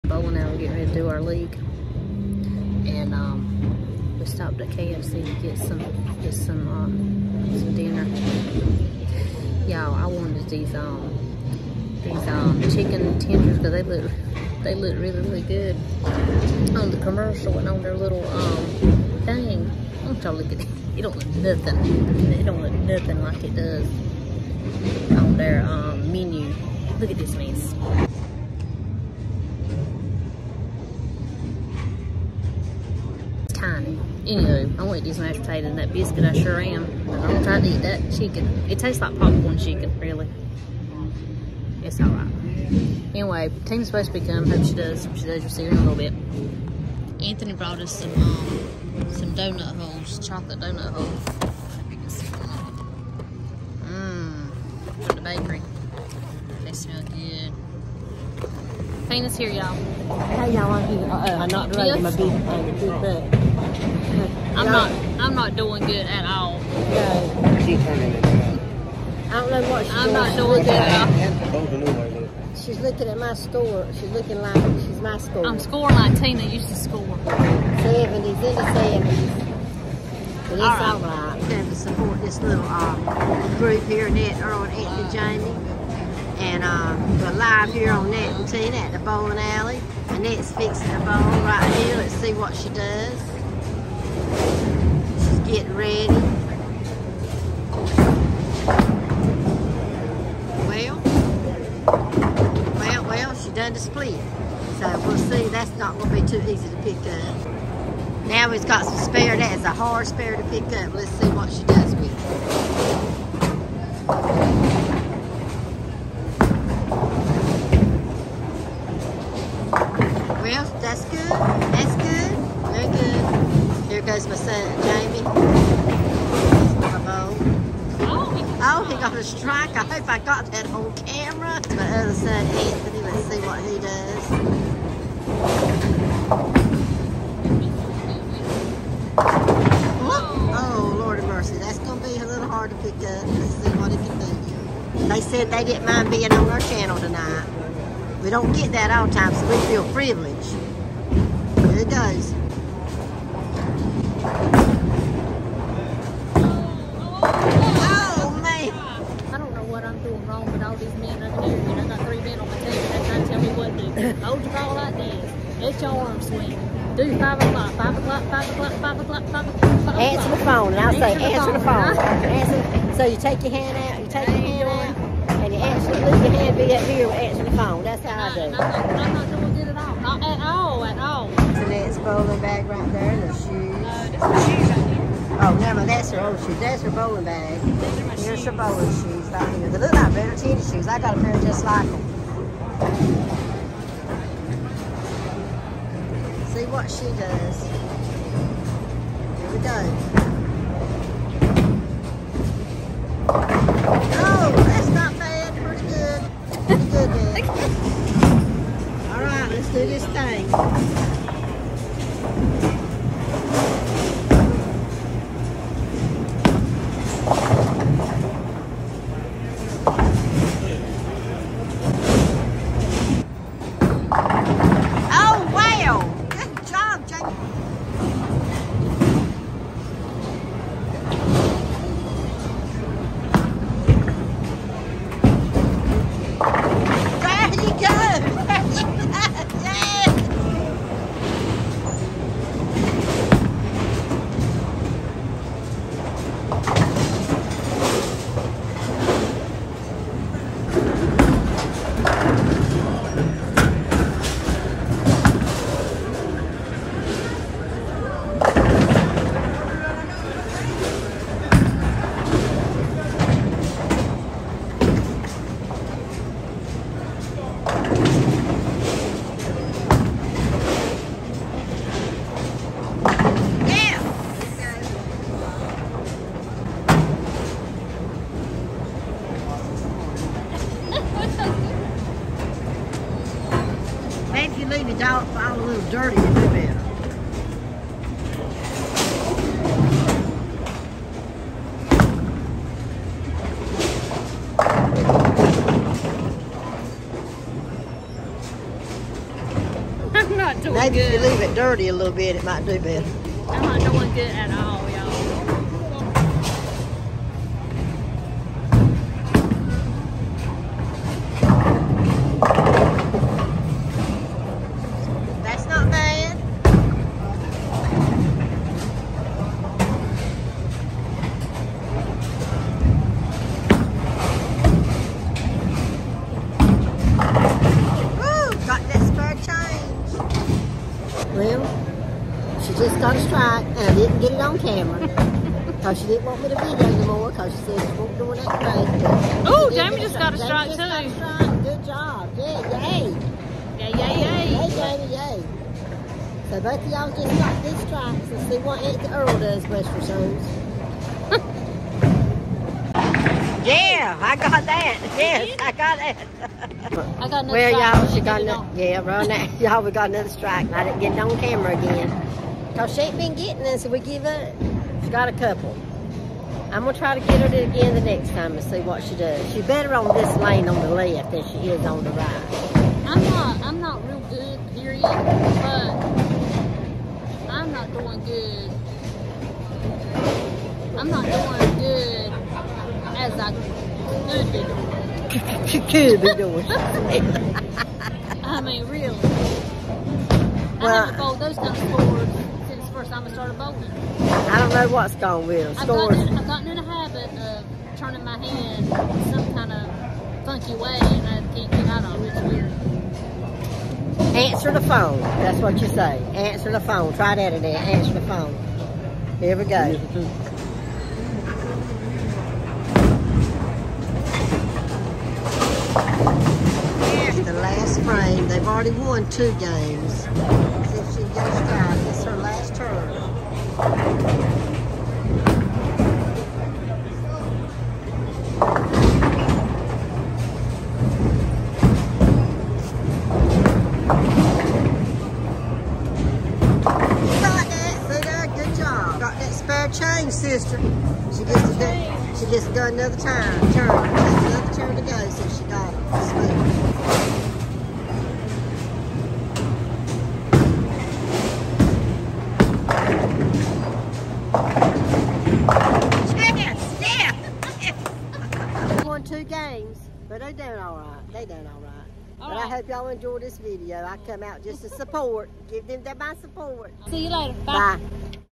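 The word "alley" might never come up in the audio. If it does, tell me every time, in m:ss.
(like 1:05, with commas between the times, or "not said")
1:29.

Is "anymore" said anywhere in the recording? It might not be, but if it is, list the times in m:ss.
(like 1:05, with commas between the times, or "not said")
5:36.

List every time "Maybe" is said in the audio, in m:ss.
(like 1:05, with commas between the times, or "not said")
5:00.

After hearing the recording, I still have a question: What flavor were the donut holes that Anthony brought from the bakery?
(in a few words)
Chocolate.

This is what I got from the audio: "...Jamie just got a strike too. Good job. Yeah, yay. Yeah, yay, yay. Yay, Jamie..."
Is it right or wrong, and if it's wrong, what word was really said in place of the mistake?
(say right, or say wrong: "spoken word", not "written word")
right.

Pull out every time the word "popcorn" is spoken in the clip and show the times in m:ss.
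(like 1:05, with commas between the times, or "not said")
0:39.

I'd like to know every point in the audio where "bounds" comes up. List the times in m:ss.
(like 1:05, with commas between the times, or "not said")
not said.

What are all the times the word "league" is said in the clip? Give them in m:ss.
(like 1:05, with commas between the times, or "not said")
0:01.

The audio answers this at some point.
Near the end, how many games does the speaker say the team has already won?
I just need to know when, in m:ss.
6:59.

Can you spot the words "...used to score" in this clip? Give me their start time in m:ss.
1:16.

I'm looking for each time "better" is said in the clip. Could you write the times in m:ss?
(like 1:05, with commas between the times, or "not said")
3:10, 4:46, 5:02, 6:09.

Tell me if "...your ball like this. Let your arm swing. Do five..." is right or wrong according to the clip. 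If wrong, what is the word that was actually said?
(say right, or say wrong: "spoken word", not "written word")
right.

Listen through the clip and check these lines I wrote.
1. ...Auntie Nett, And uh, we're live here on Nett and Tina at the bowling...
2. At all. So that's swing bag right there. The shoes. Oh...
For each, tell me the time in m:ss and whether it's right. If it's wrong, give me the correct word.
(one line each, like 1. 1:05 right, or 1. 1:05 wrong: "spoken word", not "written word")
1. 1:24 wrong: "Jamie", not "Nett"
2. 3:00 wrong: "bowling", not "swing".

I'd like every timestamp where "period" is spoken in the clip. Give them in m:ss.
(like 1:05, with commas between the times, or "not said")
6:14.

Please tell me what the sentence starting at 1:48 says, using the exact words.
Now we've got some spare, that is a hard spare to pick up.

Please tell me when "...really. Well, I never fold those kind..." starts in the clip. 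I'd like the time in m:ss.
6:28.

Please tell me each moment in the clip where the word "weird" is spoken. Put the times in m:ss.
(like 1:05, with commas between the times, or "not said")
6:42.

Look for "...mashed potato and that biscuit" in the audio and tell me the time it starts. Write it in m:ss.
0:35.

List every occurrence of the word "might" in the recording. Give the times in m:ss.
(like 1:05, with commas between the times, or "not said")
5:02.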